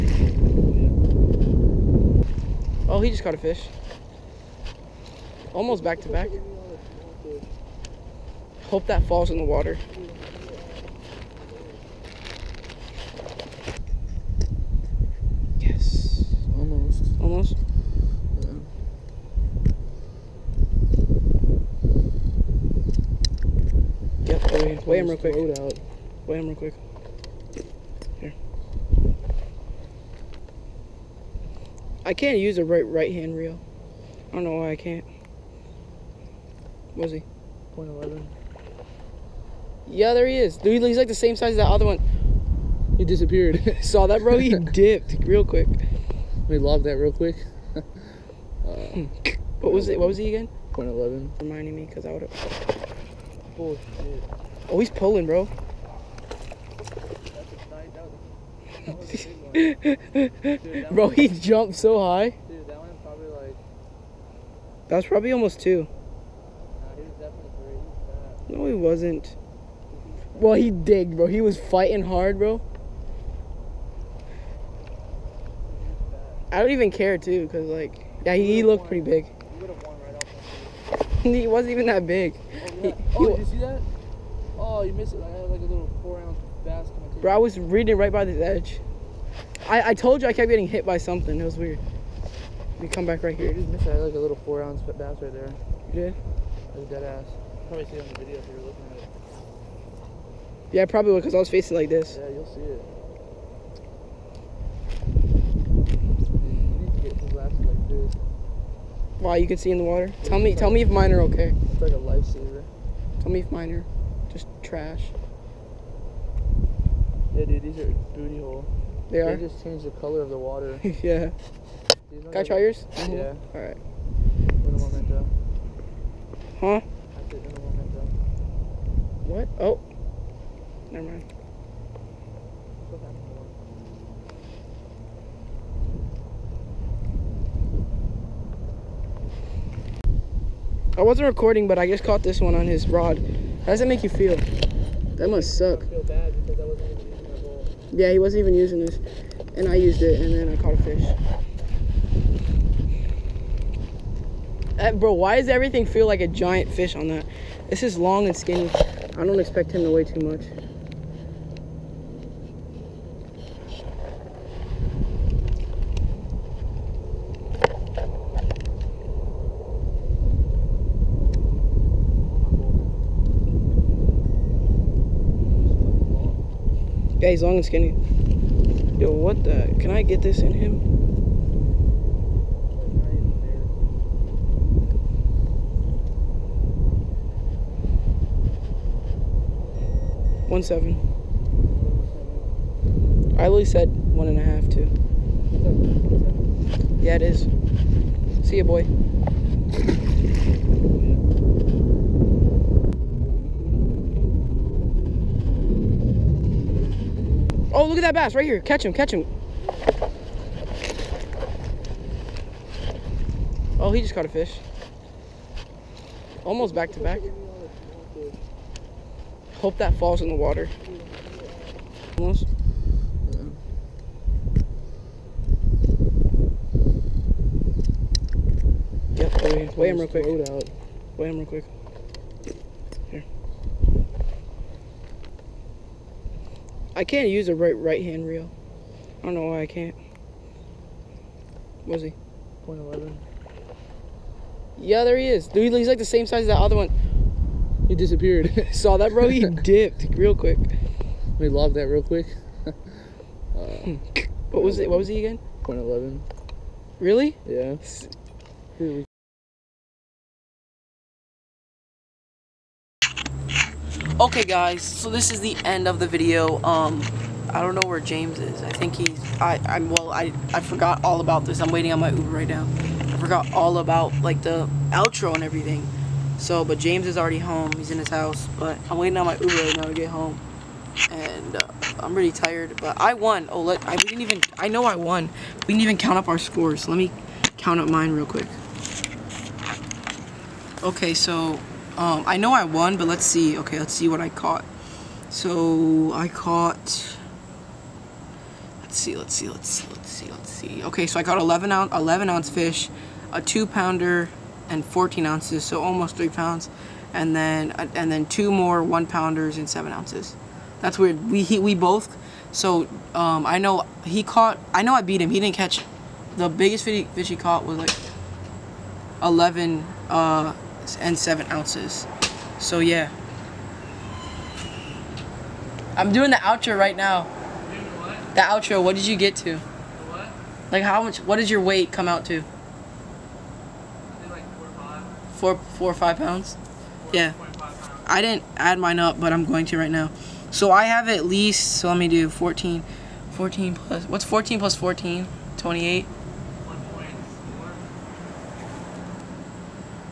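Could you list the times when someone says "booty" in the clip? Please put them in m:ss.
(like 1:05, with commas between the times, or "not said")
1:58.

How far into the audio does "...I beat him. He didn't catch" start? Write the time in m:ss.
5:14.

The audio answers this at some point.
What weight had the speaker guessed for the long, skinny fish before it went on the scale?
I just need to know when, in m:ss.
3:13.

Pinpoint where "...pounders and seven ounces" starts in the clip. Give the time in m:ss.
5:09.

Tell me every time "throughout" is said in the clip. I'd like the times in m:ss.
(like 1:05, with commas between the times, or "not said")
not said.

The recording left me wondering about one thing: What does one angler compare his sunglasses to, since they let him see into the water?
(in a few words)
lifesaver.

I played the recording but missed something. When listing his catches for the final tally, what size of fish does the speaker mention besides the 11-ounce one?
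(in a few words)
two pounder.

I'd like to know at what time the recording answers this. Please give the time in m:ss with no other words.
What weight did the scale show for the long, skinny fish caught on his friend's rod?
3:10.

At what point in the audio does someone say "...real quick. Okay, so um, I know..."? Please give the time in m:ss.
4:48.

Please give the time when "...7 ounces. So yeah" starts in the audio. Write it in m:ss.
5:21.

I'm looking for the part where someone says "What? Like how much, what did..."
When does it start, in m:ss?
5:29.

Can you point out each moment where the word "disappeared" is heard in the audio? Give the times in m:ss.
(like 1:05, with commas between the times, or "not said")
0:43, 4:07.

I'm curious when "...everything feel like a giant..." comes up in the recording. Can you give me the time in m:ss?
2:35.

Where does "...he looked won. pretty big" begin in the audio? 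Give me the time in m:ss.
1:18.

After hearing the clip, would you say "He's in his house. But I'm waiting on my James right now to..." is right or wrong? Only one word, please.
wrong.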